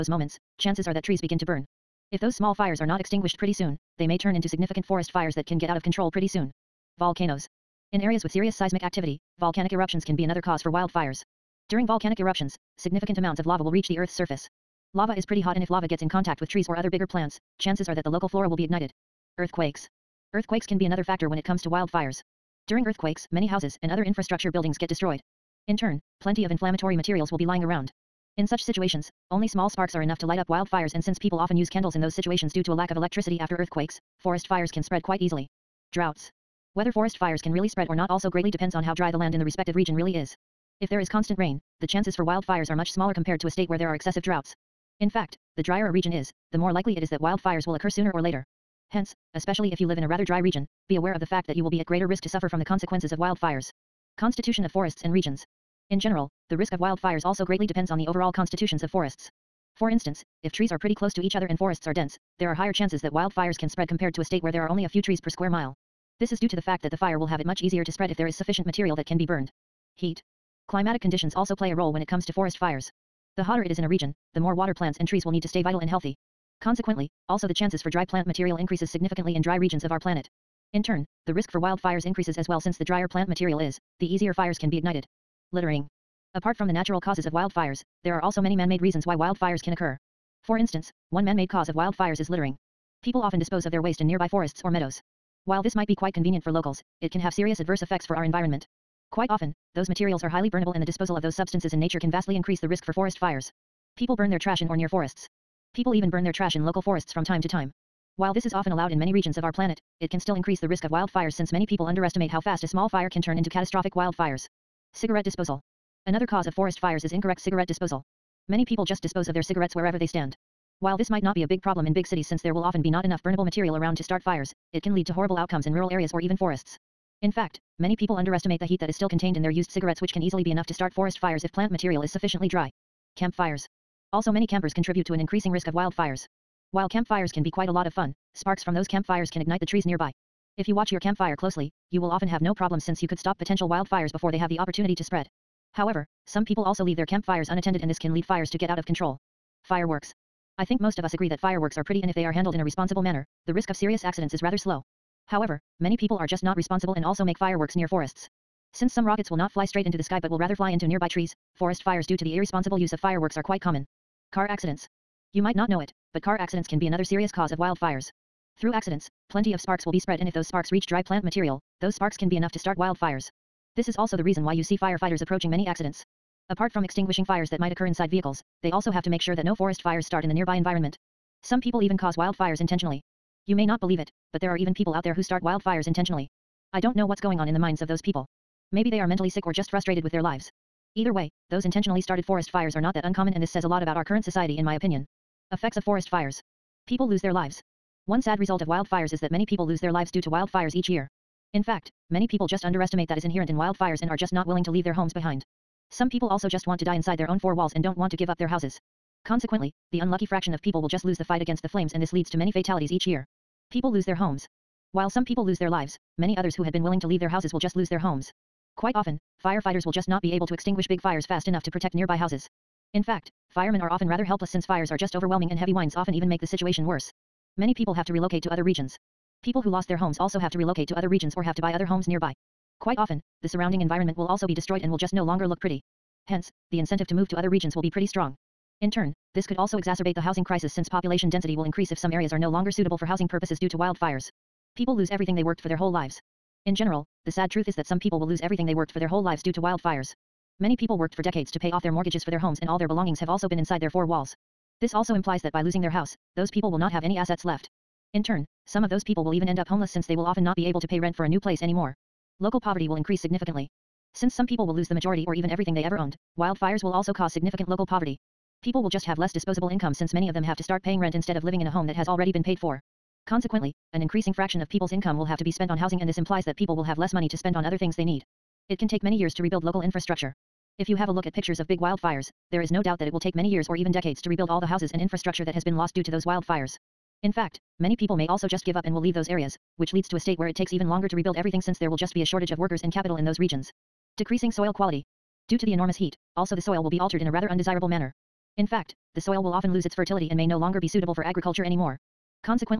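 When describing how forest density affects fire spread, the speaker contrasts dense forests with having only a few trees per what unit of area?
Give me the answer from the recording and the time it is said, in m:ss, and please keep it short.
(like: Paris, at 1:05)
square mile, at 1:05.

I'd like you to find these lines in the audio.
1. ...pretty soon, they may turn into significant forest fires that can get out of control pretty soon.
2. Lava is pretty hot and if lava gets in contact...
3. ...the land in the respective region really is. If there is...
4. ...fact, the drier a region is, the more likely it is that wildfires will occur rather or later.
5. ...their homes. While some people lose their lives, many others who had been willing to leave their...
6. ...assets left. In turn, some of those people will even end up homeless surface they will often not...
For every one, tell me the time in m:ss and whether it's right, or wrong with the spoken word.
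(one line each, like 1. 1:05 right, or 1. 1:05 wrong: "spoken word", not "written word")
1. 0:03 right
2. 0:14 right
3. 0:39 right
4. 0:45 wrong: "sooner", not "rather"
5. 3:34 right
6. 4:17 wrong: "since", not "surface".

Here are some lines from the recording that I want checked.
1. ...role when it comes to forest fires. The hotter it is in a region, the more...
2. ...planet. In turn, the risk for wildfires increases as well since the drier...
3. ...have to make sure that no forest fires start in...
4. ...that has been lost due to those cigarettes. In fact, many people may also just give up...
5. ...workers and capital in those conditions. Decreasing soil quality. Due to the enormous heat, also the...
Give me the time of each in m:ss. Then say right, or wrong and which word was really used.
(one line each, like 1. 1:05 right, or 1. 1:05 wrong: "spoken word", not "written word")
1. 1:11 right
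2. 1:19 right
3. 2:58 right
4. 4:45 wrong: "wildfires", not "cigarettes"
5. 4:52 wrong: "regions", not "conditions".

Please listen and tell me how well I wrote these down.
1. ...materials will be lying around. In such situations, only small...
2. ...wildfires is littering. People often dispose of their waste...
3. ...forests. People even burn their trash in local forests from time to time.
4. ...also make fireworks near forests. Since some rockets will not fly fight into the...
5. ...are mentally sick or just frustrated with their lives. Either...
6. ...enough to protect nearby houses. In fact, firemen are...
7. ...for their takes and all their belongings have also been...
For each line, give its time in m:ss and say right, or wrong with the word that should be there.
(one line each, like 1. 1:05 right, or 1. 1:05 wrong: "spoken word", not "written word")
1. 0:26 right
2. 1:31 right
3. 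1:44 right
4. 2:37 wrong: "straight", not "fight"
5. 3:08 right
6. 3:41 right
7. 4:12 wrong: "homes", not "takes".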